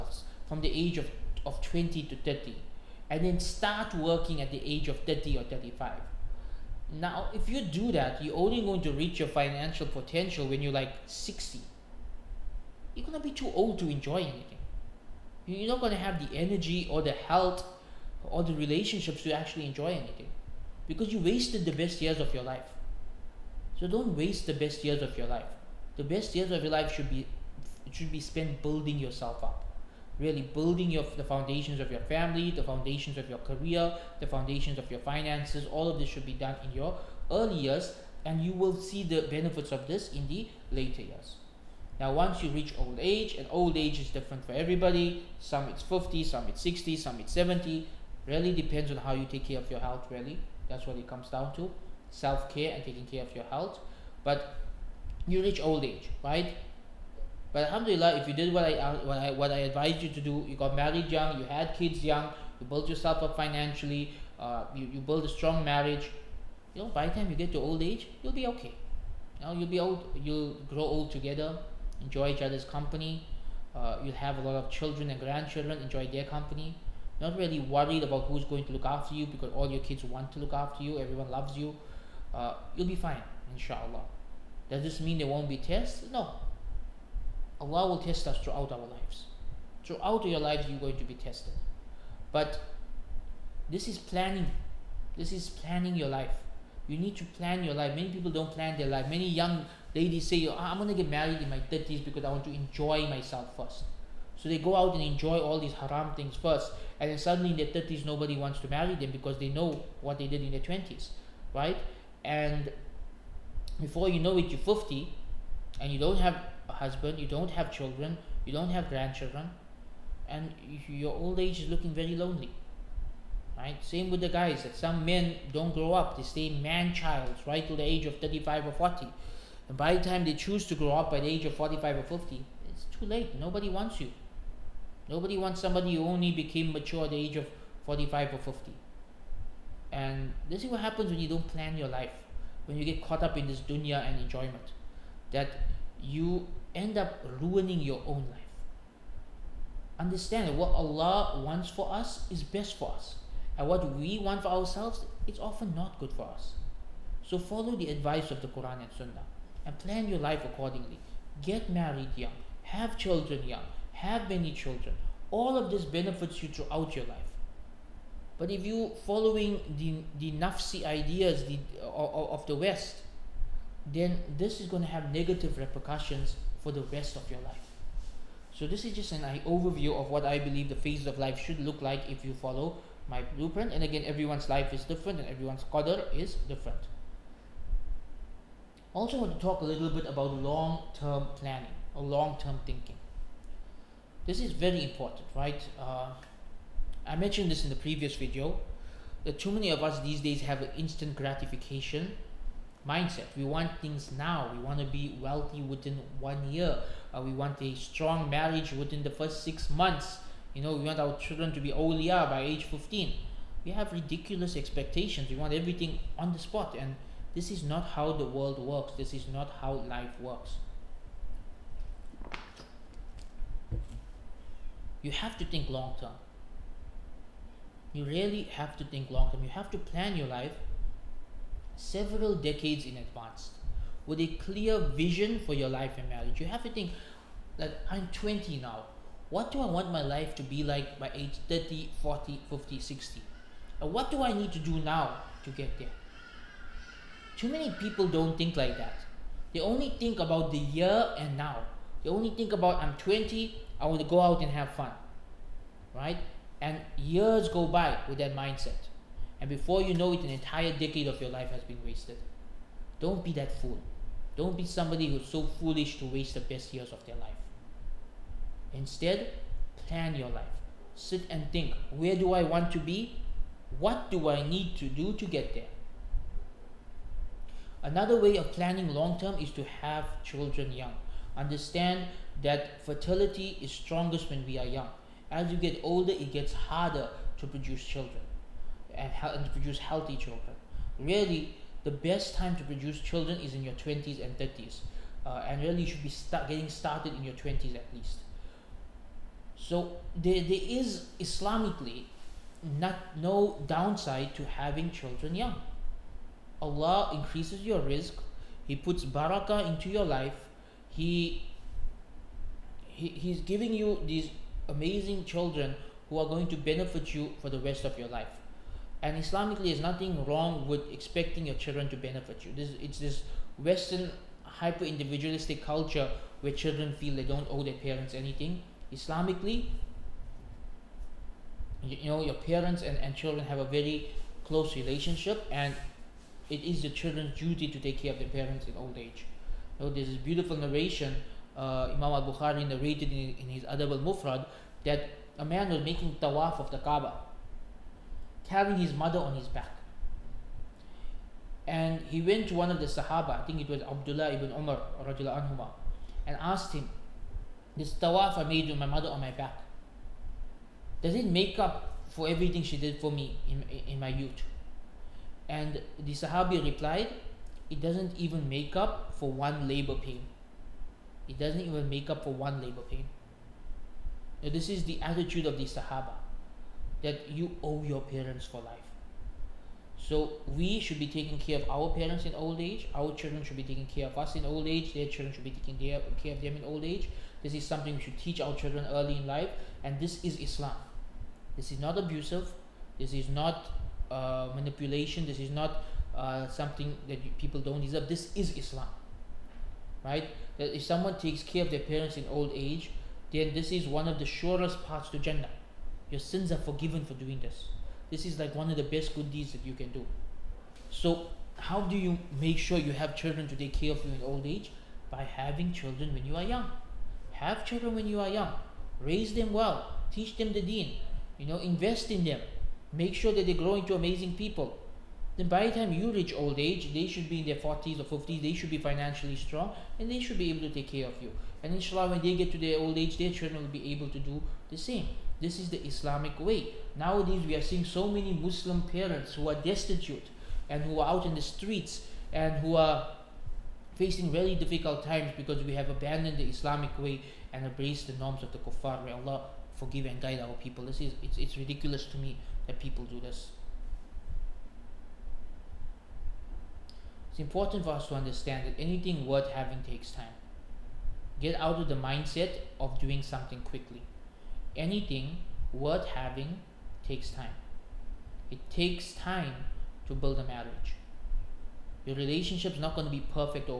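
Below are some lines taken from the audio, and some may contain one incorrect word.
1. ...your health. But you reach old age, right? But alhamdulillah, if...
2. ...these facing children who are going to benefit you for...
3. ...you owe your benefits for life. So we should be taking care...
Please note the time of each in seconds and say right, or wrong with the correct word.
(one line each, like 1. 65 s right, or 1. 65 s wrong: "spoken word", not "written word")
1. 53 s right
2. 314 s wrong: "amazing", not "facing"
3. 377 s wrong: "parents", not "benefits".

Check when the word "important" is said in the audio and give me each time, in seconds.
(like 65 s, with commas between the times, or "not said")
194 s, 457 s.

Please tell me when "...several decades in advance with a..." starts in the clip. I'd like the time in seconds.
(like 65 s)
231 s.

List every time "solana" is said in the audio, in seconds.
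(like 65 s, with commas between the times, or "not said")
not said.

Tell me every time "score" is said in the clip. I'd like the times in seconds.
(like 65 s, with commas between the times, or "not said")
not said.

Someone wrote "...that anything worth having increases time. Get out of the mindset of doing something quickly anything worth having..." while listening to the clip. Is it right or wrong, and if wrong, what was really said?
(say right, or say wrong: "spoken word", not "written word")
wrong: "takes", not "increases".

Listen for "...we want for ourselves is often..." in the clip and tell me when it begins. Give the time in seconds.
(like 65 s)
153 s.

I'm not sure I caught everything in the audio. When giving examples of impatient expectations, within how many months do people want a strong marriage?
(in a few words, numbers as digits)
6.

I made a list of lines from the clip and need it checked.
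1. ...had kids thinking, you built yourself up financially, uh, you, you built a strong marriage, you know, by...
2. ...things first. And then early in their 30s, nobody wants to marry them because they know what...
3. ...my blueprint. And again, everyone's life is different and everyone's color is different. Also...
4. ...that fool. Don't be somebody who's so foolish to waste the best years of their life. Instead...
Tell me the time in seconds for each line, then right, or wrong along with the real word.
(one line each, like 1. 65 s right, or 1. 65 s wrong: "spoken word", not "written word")
1. 61 s wrong: "young", not "thinking"
2. 106 s wrong: "suddenly", not "early"
3. 183 s right
4. 263 s right.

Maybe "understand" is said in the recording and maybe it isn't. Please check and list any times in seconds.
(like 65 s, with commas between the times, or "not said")
149 s, 281 s, 458 s.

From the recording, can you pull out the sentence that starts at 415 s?
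By having children when you are young.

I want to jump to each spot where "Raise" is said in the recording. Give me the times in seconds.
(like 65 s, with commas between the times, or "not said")
419 s.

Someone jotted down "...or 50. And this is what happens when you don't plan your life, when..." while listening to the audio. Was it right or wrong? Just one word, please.
right.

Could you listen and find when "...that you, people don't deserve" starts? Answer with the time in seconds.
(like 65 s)
397 s.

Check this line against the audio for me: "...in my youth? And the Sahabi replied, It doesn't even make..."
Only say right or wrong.
right.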